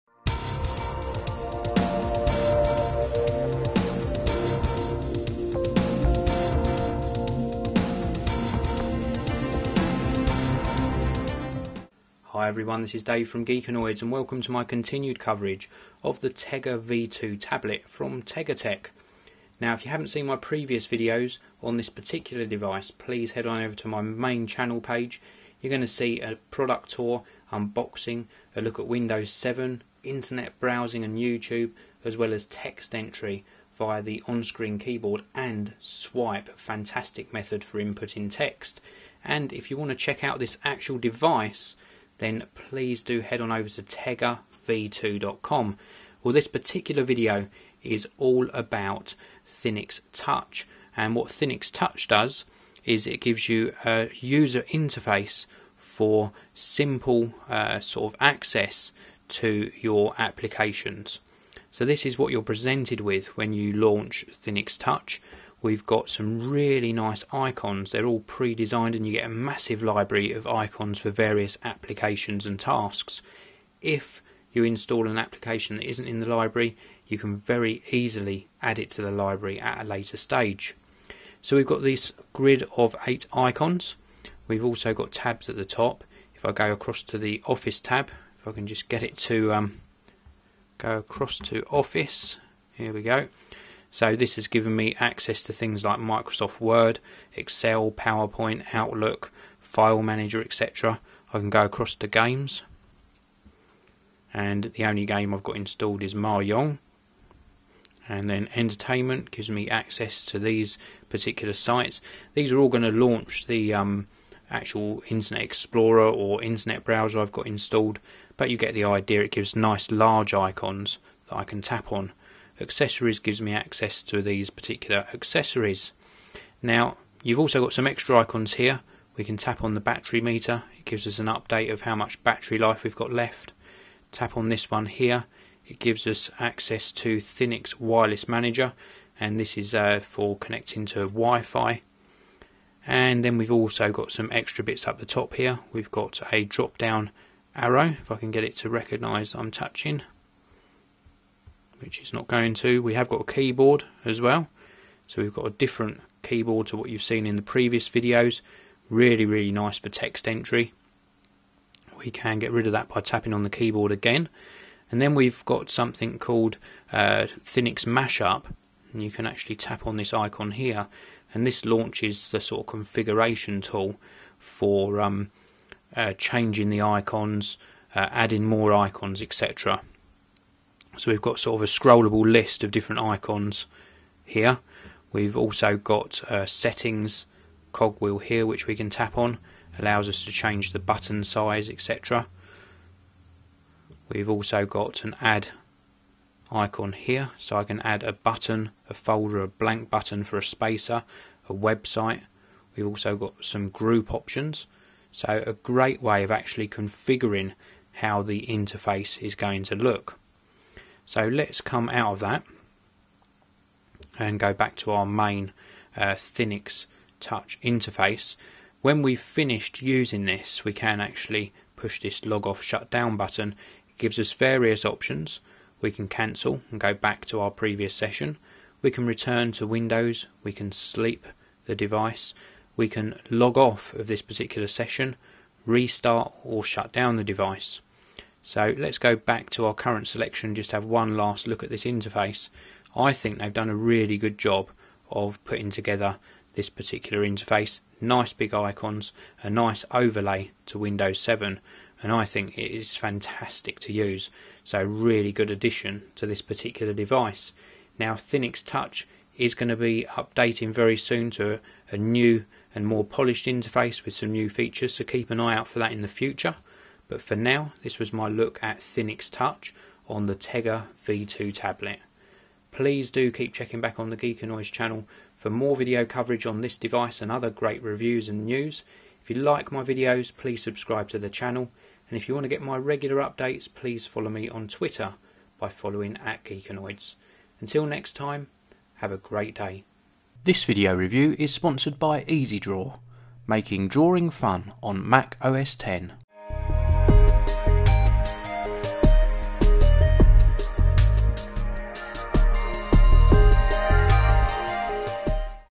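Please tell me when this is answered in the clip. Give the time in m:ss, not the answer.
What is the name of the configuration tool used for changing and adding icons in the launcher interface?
2:47.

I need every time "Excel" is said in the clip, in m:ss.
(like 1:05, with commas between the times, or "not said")
1:37.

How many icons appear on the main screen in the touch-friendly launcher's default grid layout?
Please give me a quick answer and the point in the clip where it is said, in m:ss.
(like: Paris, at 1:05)
8, at 1:23.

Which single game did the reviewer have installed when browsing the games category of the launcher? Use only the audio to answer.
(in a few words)
Mahjong.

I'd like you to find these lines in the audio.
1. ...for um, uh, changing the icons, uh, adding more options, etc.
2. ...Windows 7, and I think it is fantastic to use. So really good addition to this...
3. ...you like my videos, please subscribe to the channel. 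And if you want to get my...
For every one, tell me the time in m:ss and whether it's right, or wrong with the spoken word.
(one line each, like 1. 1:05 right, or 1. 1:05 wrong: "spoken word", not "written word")
1. 2:54 wrong: "icons", not "options"
2. 4:10 right
3. 4:39 right.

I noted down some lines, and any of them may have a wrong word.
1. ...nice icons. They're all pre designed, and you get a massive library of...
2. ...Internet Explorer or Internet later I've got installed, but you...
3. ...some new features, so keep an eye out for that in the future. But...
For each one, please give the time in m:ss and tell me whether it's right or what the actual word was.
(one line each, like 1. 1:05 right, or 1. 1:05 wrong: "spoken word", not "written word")
1. 1:06 right
2. 1:55 wrong: "browser", not "later"
3. 4:24 right.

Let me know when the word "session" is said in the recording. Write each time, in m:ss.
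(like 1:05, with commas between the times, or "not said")
3:47, 3:54.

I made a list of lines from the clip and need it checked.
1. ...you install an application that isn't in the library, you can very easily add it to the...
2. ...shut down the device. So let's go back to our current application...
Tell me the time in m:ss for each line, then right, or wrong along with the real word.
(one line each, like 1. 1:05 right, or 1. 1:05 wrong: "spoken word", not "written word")
1. 1:14 right
2. 3:56 wrong: "selection", not "application".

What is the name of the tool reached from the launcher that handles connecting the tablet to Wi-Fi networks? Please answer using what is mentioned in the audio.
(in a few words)
Thinix Wireless Manager.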